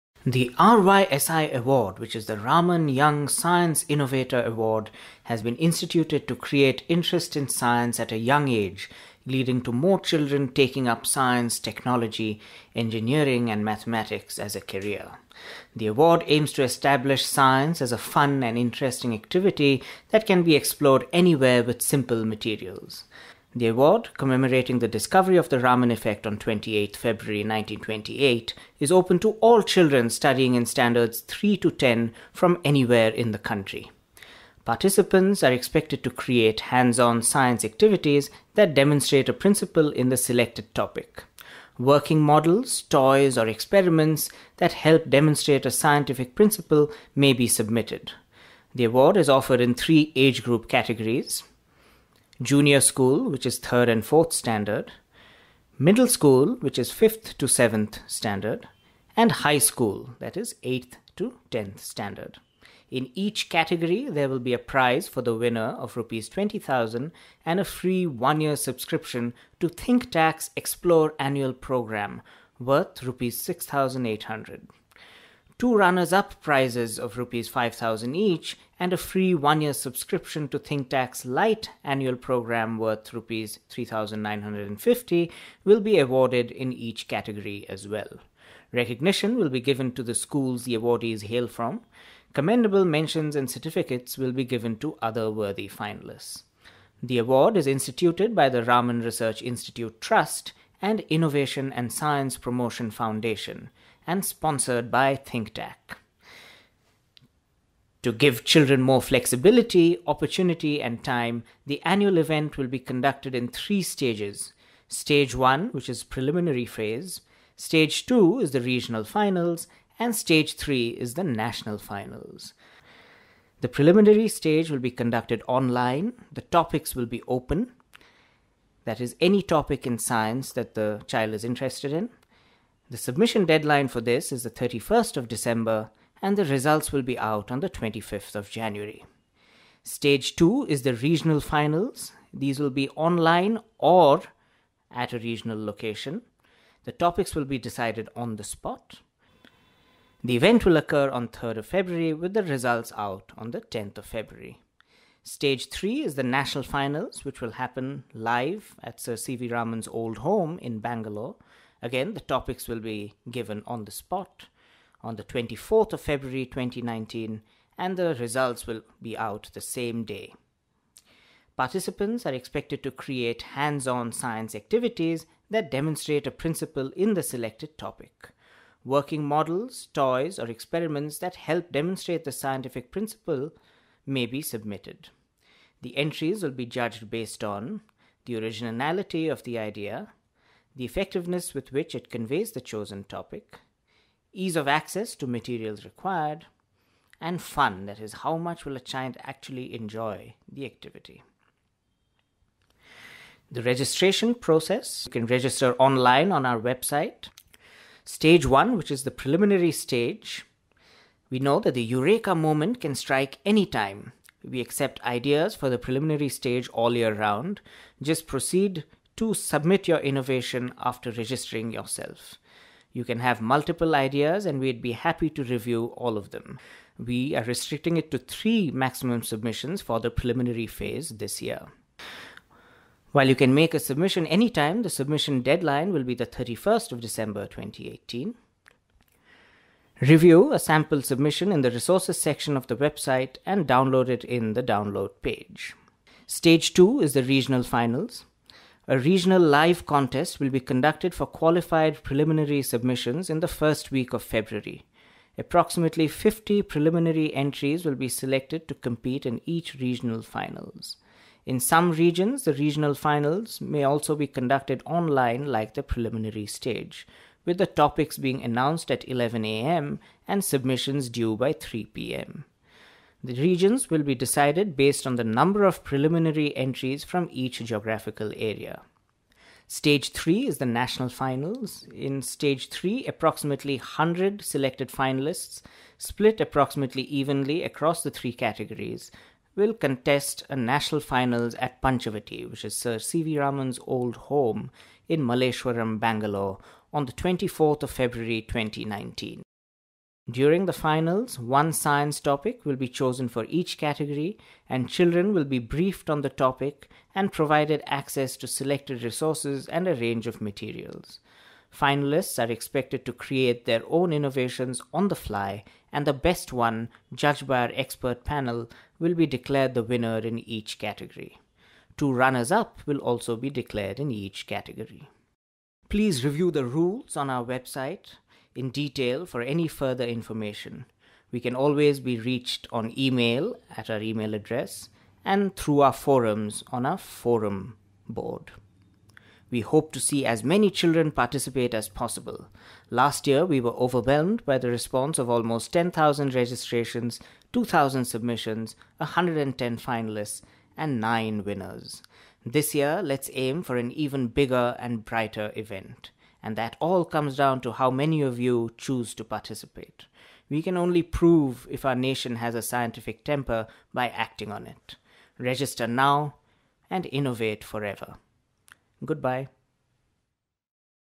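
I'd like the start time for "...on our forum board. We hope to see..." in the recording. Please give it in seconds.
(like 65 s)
336 s.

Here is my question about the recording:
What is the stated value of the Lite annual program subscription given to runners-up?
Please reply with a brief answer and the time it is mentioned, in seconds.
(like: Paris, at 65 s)
Rs 3950, at 83 s.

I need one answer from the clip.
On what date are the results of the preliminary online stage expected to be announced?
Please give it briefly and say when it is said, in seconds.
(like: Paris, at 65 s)
25th of January, at 137 s.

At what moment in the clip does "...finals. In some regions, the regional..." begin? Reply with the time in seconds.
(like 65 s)
260 s.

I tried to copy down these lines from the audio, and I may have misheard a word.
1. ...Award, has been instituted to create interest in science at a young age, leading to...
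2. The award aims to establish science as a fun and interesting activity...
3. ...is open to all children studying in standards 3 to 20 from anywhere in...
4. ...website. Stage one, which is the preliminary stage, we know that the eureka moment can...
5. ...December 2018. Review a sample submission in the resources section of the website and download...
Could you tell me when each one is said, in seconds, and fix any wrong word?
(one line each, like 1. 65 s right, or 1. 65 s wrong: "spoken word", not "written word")
1. 4 s right
2. 15 s right
3. 28 s wrong: "10", not "20"
4. 206 s right
5. 237 s right.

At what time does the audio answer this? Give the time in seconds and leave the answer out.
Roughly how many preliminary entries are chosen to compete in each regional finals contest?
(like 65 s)
255 s.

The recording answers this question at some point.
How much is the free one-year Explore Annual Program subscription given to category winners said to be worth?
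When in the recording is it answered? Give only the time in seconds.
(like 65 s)
73 s.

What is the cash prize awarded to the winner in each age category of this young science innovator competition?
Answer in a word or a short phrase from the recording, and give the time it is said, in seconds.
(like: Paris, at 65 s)
Rs 20,000, at 65 s.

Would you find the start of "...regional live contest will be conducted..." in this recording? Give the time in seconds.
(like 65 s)
248 s.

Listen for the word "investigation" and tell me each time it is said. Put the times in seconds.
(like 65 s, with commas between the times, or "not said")
not said.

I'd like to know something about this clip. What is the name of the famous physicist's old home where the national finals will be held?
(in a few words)
Panchavati.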